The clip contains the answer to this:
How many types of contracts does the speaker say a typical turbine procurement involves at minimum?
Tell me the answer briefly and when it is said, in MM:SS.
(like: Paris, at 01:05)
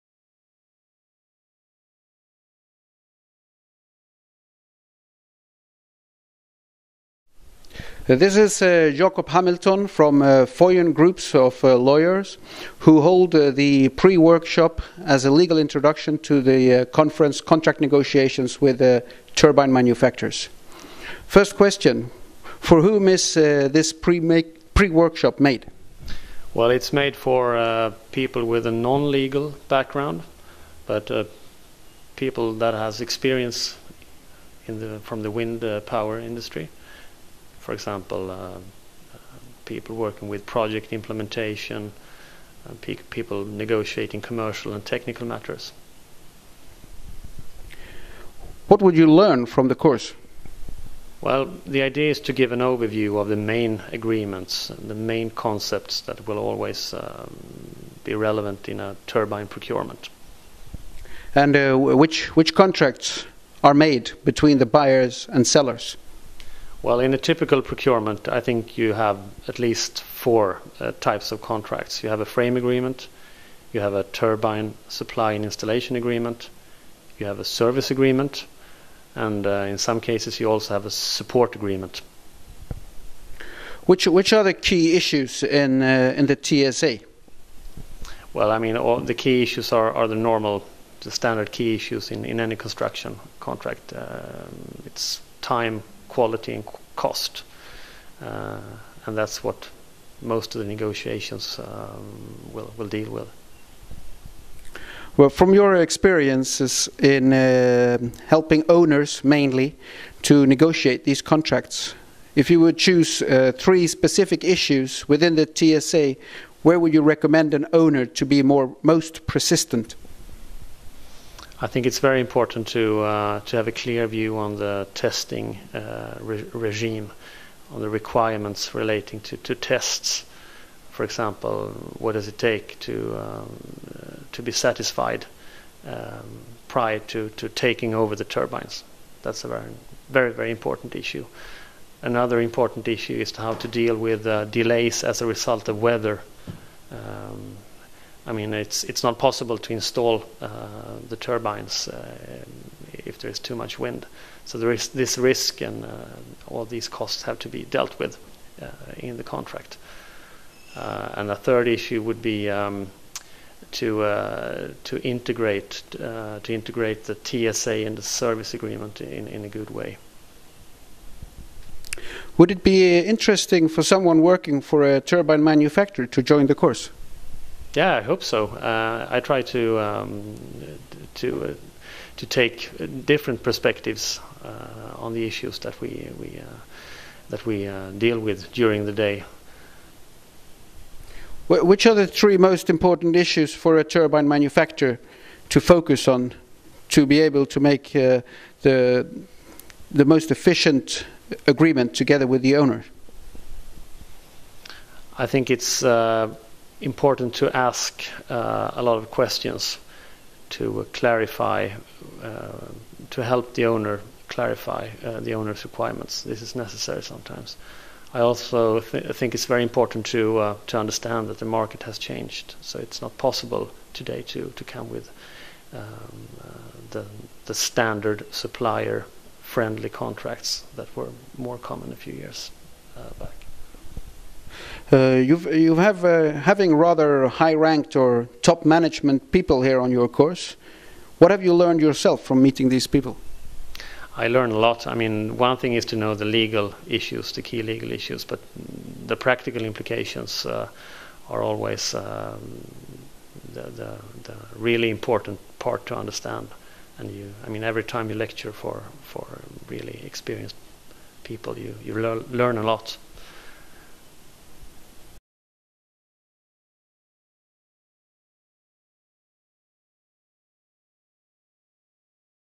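4, at 01:10.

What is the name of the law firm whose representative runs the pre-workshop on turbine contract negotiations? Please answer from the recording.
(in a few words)
Foyen.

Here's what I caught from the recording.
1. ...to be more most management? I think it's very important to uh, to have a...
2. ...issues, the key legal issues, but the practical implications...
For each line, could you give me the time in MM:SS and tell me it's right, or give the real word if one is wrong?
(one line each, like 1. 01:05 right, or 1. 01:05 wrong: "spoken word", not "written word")
1. 01:58 wrong: "persistent", not "management"
2. 04:06 right.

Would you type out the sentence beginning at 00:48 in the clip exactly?
What would you learn from the course?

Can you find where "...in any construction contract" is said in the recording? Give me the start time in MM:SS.
01:32.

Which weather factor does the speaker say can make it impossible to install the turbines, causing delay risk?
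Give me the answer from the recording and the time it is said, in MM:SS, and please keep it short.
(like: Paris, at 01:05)
Too much wind, at 02:33.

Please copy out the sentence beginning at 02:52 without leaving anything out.
Would it be interesting for someone working for a turbine manufacturer to join the course?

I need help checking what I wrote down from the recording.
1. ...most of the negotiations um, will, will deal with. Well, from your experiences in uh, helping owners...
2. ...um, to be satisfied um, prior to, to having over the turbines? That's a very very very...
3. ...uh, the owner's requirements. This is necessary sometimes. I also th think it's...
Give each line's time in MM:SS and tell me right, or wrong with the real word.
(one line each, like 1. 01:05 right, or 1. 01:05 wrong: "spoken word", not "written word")
1. 01:40 right
2. 02:13 wrong: "taking", not "having"
3. 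03:35 right.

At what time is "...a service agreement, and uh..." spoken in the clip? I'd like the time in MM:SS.
01:17.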